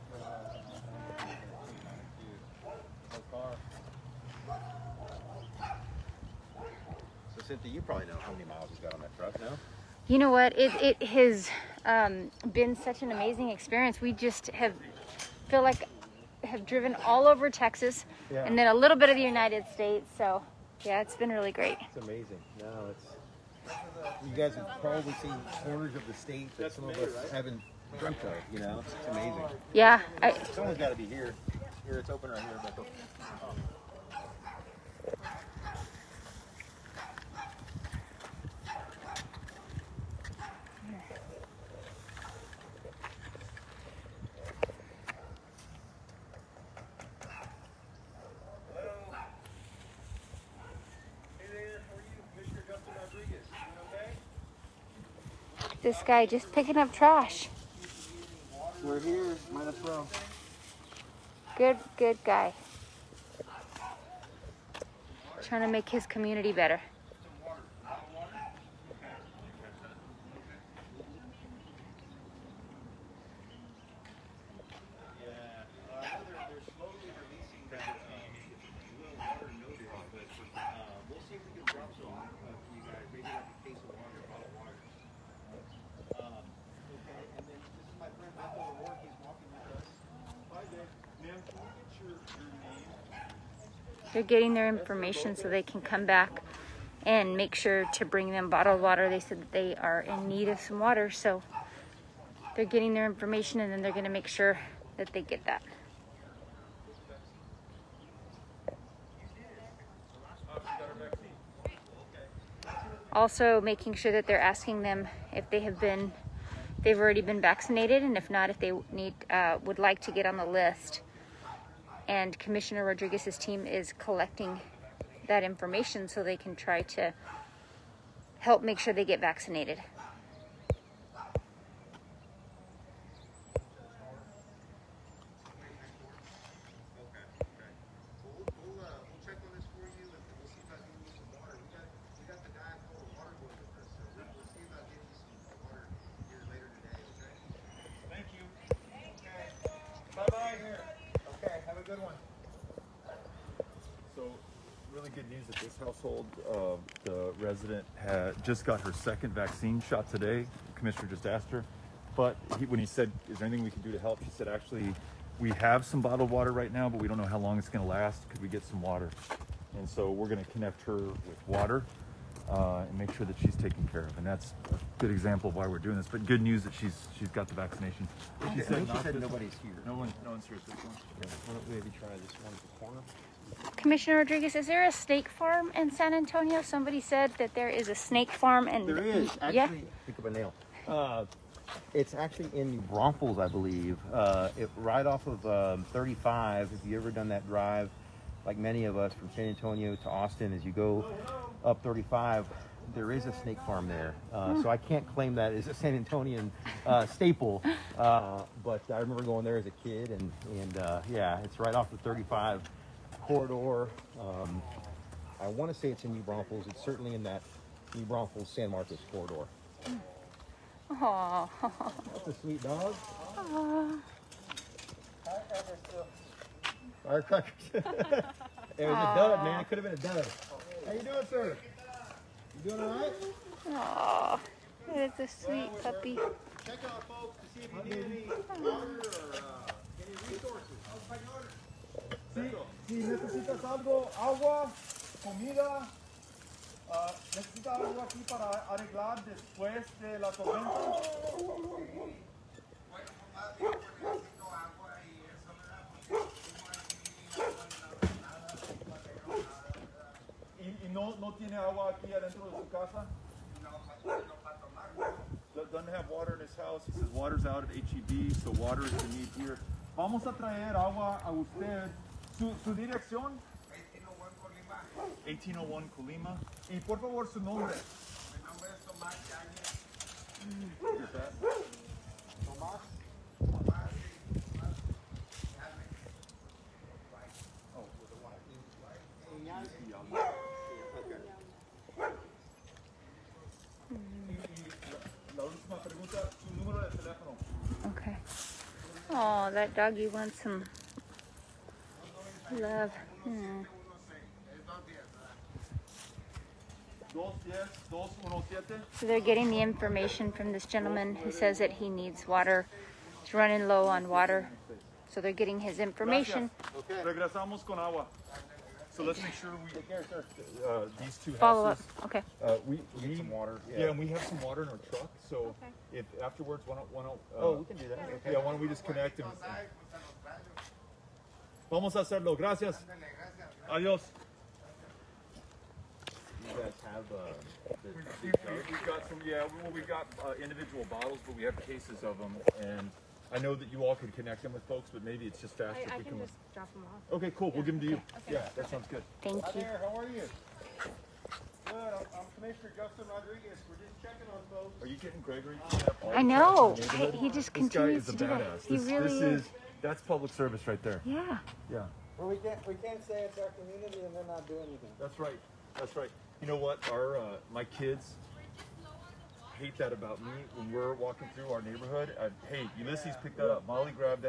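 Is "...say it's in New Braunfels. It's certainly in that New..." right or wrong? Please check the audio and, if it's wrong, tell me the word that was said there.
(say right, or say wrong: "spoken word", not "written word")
right.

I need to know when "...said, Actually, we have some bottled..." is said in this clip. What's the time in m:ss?
2:44.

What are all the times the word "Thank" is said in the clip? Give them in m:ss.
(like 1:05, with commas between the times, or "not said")
5:49.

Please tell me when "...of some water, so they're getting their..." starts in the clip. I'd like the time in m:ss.
1:40.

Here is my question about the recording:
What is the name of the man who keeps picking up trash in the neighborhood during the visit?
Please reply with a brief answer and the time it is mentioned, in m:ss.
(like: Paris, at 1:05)
Gregory, at 5:55.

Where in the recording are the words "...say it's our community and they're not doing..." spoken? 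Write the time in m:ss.
6:03.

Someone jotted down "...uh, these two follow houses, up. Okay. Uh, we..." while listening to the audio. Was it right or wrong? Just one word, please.
right.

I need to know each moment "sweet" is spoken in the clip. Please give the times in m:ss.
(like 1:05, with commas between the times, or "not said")
3:42.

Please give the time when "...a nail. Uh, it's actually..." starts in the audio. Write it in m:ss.
3:10.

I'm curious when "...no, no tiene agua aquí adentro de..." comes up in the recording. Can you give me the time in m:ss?
4:20.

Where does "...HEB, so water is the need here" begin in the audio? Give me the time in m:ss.
4:27.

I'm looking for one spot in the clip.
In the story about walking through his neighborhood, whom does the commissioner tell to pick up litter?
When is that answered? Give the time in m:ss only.
6:12.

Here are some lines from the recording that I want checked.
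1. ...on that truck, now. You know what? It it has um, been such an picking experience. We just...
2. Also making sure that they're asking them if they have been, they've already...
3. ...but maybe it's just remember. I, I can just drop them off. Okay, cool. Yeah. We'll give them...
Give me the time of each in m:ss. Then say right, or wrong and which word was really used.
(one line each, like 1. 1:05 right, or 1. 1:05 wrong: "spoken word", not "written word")
1. 0:08 wrong: "amazing", not "picking"
2. 1:53 right
3. 5:44 wrong: "faster", not "remember".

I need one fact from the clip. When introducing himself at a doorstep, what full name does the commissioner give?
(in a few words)
Justin Rodriguez.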